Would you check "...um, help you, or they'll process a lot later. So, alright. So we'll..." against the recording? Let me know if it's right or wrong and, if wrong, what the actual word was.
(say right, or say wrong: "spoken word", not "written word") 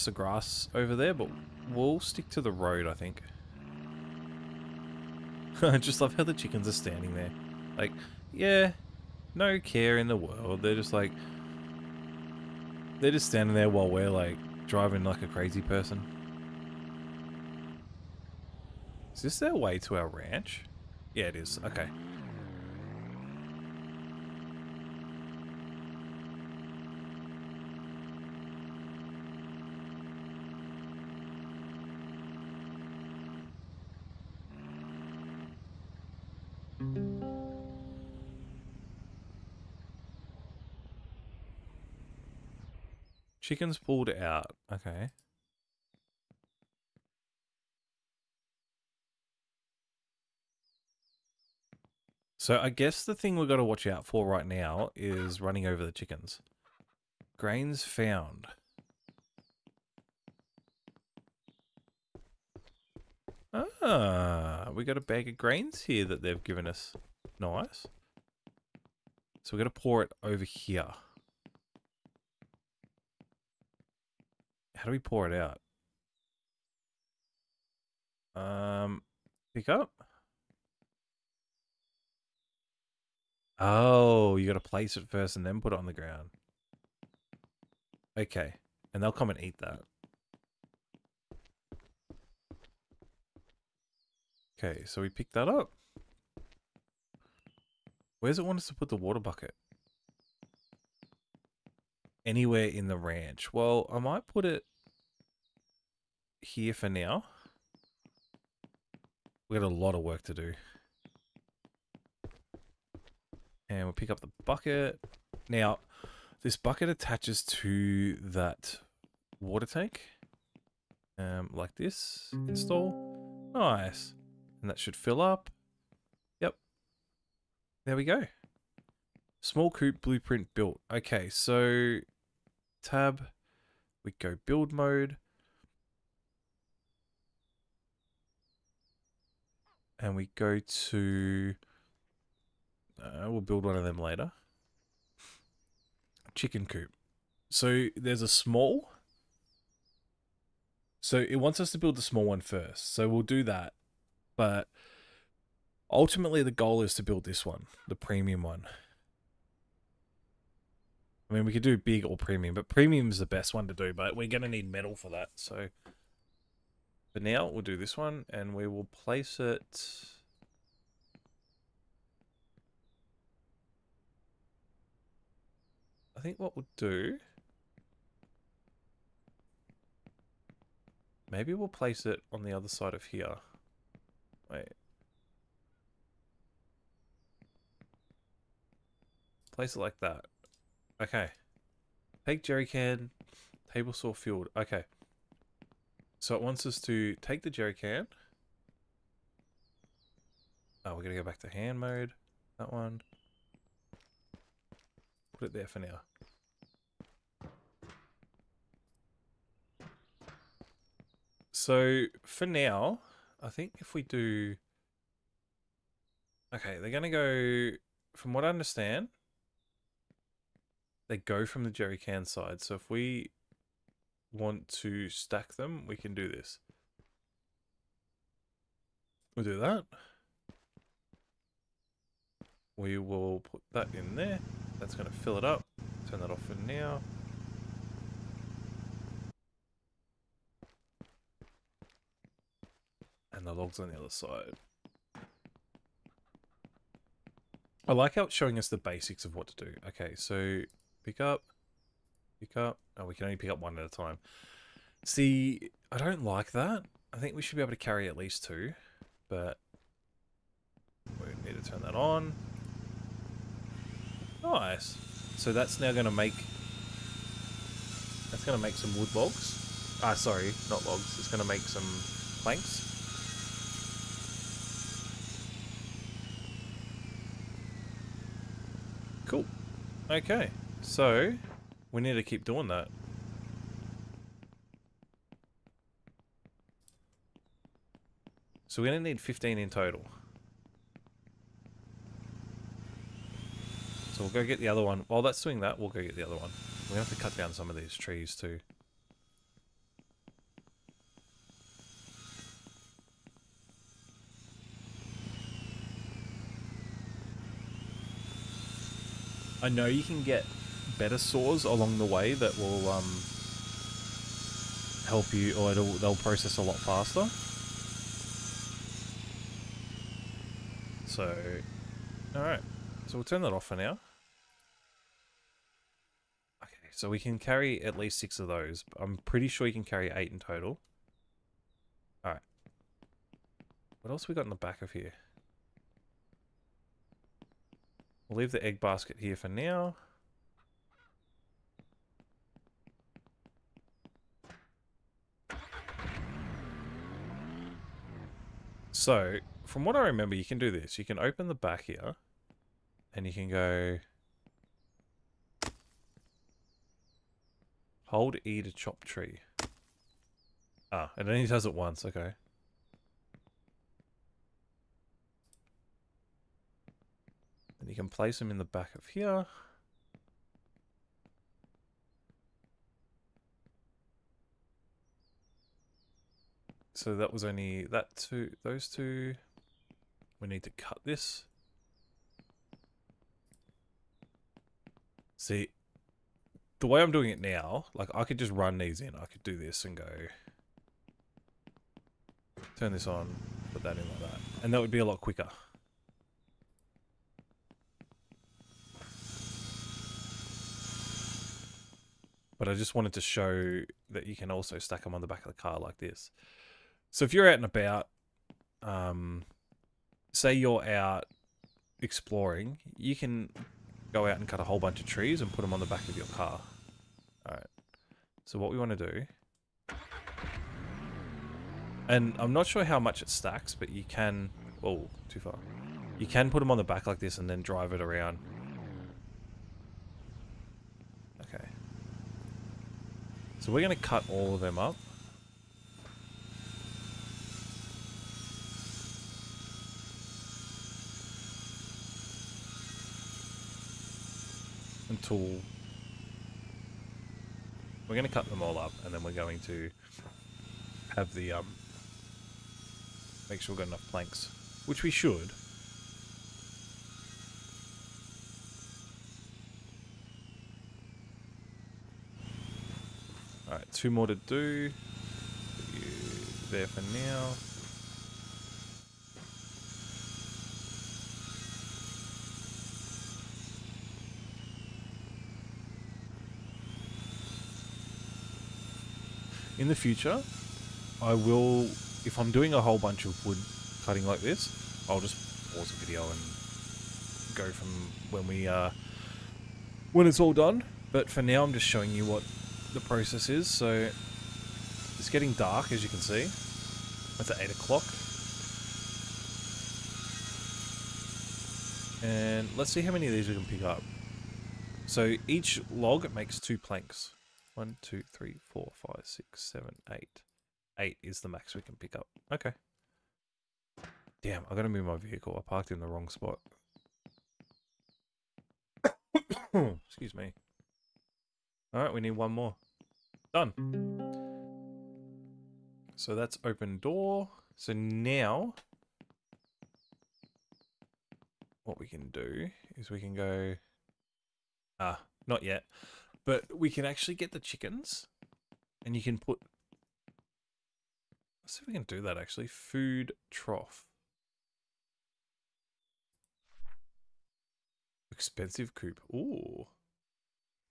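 wrong: "faster", not "later".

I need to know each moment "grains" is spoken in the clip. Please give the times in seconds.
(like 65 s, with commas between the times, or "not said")
57 s, 65 s.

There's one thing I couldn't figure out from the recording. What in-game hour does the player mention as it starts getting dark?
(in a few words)
8 o'clock.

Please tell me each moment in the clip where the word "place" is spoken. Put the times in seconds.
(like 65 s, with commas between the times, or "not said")
84 s, 168 s, 181 s, 189 s, 368 s.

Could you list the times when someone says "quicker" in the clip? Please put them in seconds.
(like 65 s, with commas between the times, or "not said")
395 s.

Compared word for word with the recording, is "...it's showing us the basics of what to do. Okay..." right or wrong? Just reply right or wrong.
right.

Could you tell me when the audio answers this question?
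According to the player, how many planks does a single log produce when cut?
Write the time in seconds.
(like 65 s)
506 s.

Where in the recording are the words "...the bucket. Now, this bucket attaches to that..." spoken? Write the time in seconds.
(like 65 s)
114 s.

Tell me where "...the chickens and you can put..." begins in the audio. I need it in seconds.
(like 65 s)
537 s.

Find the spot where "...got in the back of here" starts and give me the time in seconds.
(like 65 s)
334 s.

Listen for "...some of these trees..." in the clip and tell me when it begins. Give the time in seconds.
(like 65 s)
297 s.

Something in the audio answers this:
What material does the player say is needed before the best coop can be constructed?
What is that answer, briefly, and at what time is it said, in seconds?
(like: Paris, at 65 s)
Metal, at 164 s.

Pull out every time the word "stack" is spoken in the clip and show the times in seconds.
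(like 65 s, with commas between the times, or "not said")
225 s, 404 s, 423 s.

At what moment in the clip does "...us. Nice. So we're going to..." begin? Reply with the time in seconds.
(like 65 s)
66 s.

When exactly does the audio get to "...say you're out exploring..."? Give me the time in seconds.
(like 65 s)
410 s.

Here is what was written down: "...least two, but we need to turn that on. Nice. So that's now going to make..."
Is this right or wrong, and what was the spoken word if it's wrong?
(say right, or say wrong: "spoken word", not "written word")
right.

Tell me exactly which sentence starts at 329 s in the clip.
I'm pretty sure you can carry eight in total.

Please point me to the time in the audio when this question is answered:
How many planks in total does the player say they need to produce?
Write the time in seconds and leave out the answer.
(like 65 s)
289 s.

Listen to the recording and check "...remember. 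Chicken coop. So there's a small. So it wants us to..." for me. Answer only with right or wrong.
wrong.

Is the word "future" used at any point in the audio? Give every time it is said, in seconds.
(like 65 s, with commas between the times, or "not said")
479 s.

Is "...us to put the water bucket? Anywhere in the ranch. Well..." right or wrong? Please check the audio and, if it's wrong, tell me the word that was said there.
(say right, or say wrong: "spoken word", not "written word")
right.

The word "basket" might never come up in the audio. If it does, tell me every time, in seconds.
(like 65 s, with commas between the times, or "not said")
338 s.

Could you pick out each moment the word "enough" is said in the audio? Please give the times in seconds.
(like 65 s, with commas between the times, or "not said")
453 s.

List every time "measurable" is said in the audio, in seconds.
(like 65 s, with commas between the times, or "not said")
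not said.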